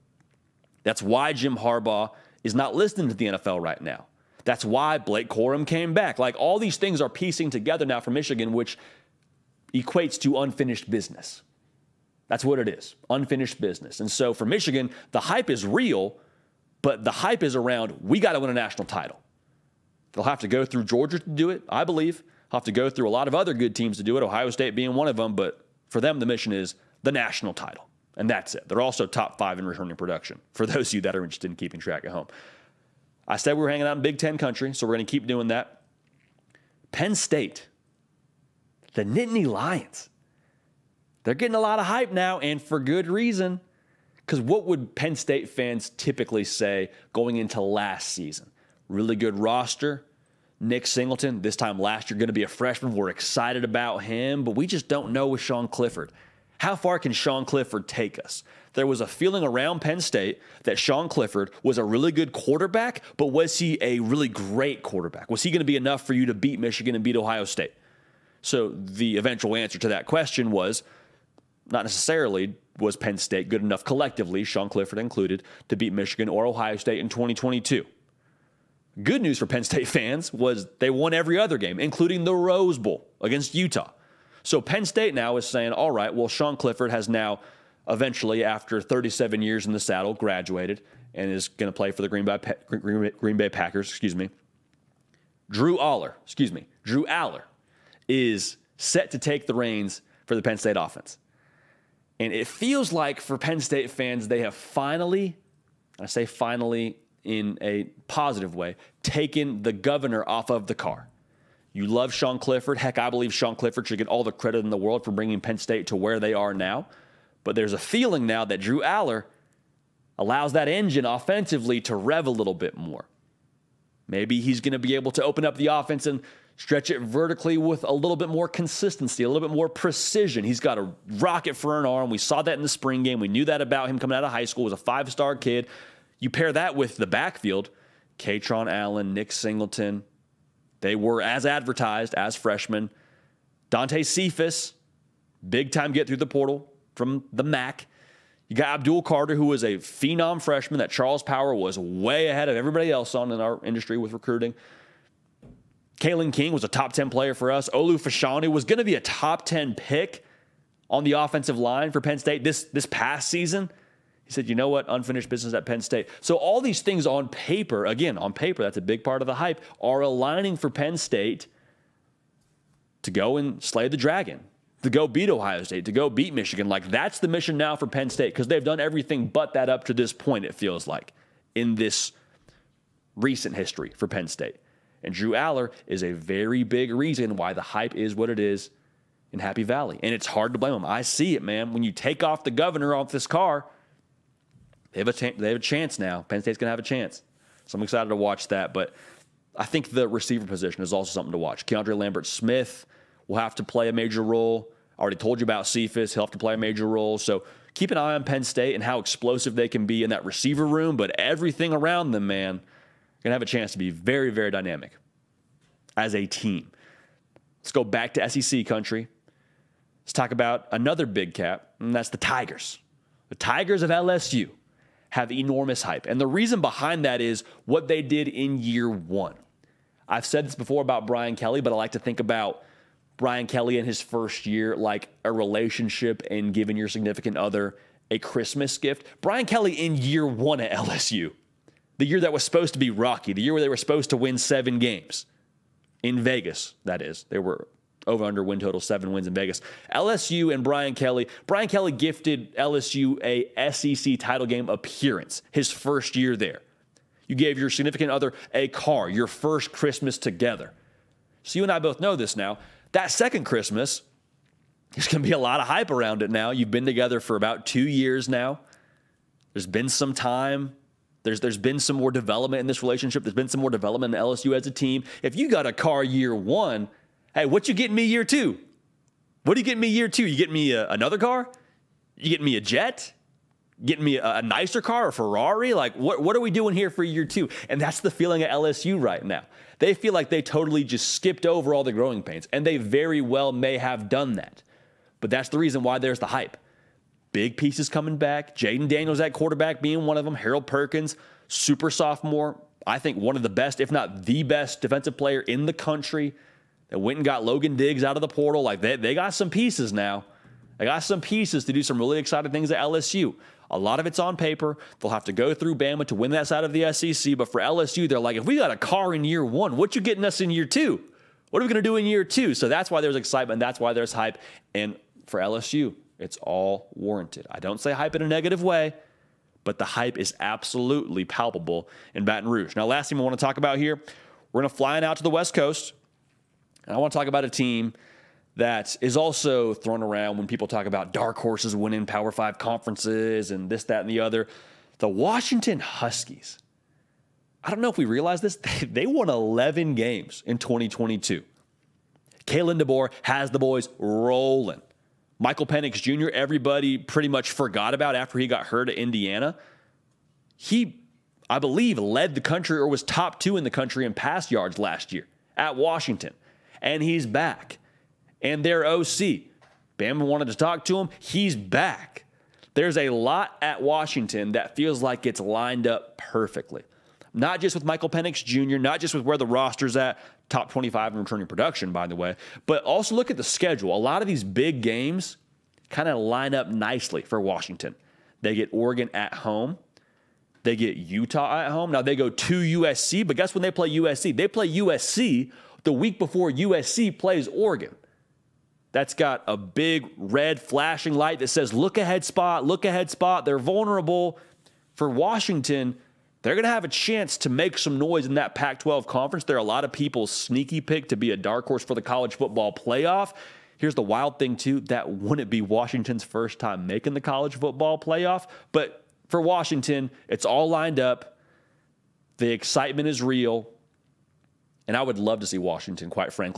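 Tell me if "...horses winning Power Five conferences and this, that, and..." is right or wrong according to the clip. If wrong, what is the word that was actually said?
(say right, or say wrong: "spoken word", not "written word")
right.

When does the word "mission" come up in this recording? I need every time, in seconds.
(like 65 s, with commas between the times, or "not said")
26 s, 177 s.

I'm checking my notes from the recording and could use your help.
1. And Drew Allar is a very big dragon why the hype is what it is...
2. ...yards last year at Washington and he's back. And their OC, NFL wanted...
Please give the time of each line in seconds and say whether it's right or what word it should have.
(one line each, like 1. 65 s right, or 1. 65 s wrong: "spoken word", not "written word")
1. 185 s wrong: "reason", not "dragon"
2. 364 s wrong: "Bama", not "NFL".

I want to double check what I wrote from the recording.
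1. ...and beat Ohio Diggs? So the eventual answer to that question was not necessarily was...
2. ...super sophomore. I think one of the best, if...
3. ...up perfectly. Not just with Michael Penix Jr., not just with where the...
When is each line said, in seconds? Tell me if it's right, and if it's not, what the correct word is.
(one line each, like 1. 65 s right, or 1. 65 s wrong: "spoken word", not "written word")
1. 66 s wrong: "State", not "Diggs"
2. 301 s right
3. 375 s right.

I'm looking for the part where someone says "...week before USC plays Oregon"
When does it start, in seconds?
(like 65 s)
395 s.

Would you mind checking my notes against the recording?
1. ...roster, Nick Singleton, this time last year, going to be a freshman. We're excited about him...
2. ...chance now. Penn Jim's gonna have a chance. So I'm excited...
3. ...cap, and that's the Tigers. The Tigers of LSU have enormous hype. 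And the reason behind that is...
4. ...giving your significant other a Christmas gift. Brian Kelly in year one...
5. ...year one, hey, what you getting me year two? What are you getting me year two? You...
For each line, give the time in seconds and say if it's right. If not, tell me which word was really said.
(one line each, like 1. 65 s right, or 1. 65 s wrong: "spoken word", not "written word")
1. 49 s right
2. 195 s wrong: "State", not "Jim"
3. 221 s right
4. 236 s right
5. 276 s right.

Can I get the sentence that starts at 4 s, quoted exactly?
That's why Blake Corum came back.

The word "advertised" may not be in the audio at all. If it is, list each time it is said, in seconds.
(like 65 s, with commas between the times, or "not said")
141 s.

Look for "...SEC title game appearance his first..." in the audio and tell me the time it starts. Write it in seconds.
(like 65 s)
253 s.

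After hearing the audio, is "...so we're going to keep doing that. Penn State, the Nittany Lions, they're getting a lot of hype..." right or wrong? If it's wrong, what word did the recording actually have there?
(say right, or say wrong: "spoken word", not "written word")
right.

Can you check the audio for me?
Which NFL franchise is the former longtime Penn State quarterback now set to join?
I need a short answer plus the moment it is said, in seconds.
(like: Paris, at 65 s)
Green Bay Packers, at 92 s.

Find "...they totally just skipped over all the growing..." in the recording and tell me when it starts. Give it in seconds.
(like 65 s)
290 s.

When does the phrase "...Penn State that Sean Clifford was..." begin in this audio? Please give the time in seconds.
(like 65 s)
59 s.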